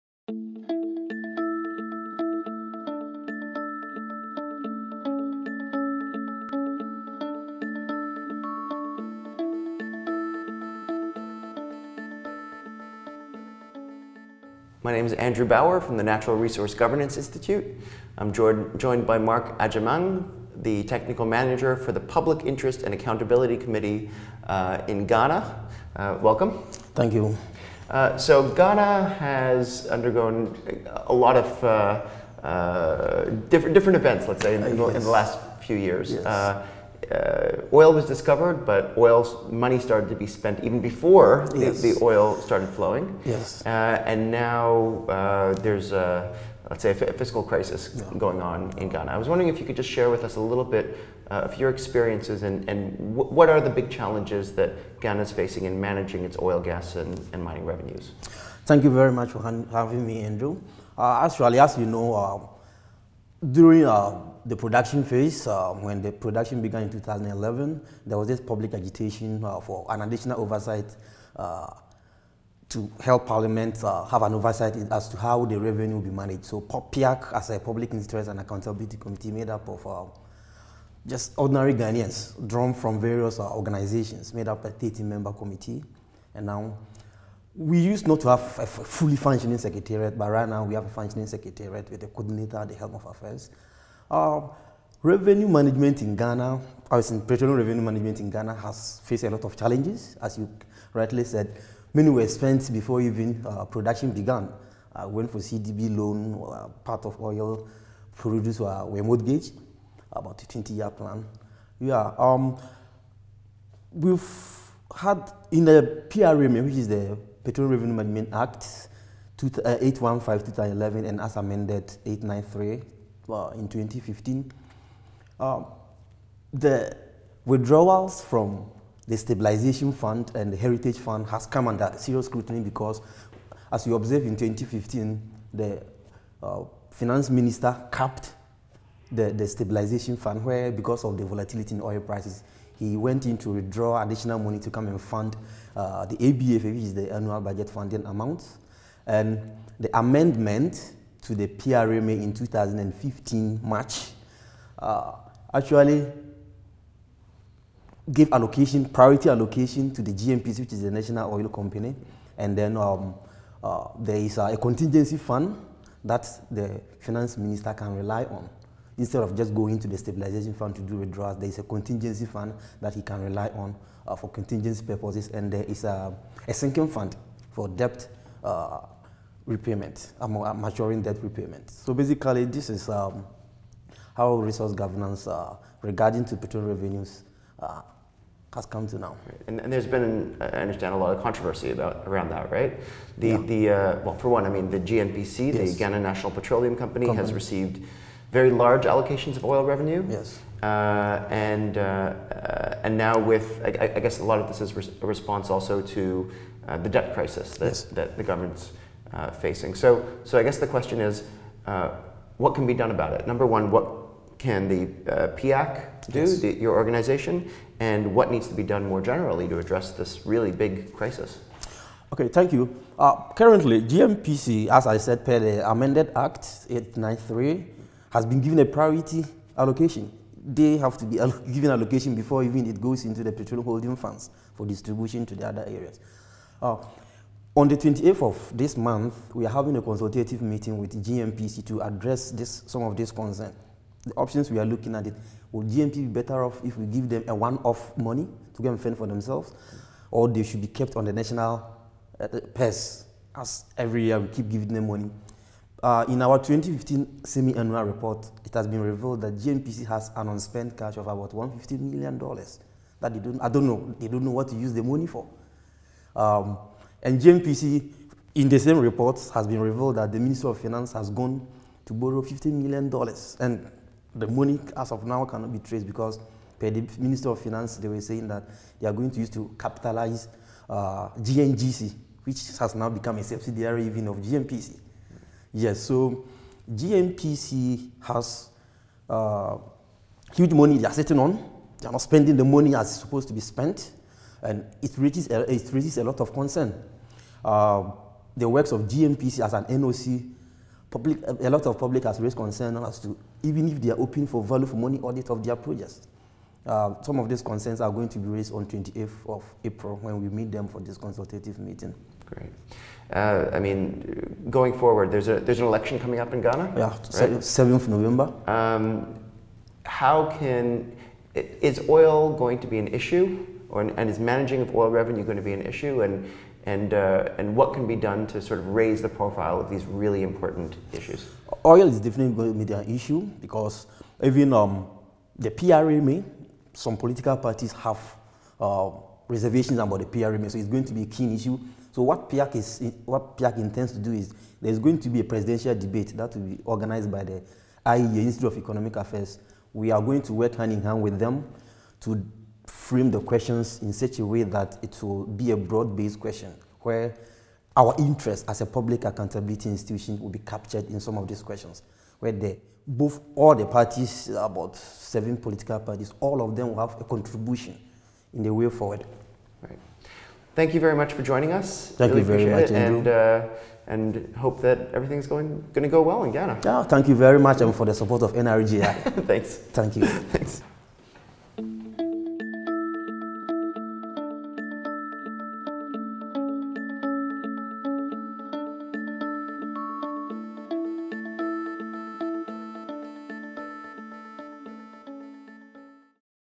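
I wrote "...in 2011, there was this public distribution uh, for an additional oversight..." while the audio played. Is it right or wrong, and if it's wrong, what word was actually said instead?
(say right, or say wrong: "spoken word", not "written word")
wrong: "agitation", not "distribution".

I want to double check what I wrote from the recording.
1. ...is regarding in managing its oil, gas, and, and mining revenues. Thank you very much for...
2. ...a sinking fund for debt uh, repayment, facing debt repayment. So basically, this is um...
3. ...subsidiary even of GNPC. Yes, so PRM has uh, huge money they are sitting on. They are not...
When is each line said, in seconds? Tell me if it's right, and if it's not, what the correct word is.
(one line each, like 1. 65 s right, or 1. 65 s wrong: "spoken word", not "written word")
1. 55 s wrong: "facing", not "regarding"
2. 176 s wrong: "maturing", not "facing"
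3. 283 s wrong: "GNPC", not "PRM".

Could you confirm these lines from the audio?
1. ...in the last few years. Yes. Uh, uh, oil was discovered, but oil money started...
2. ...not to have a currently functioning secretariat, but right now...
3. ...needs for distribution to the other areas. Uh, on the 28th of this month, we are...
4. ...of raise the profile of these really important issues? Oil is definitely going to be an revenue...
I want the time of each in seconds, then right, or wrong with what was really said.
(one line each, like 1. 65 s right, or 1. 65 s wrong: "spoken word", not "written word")
1. 34 s right
2. 88 s wrong: "fully", not "currently"
3. 233 s wrong: "funds", not "needs"
4. 328 s wrong: "issue", not "revenue".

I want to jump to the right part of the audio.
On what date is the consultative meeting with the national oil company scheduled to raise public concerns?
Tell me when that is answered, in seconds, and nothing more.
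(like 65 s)
308 s.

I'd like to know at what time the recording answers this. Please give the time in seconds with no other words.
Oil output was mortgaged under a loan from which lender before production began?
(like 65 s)
105 s.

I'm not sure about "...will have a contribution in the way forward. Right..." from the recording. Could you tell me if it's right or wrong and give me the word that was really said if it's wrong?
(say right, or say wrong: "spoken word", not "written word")
right.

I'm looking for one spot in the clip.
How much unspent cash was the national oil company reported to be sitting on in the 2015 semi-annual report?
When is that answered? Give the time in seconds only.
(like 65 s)
261 s.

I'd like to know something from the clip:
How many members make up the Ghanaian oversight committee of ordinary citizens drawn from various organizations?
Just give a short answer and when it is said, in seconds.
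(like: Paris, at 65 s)
30, at 84 s.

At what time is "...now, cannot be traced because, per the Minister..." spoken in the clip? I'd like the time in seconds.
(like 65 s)
275 s.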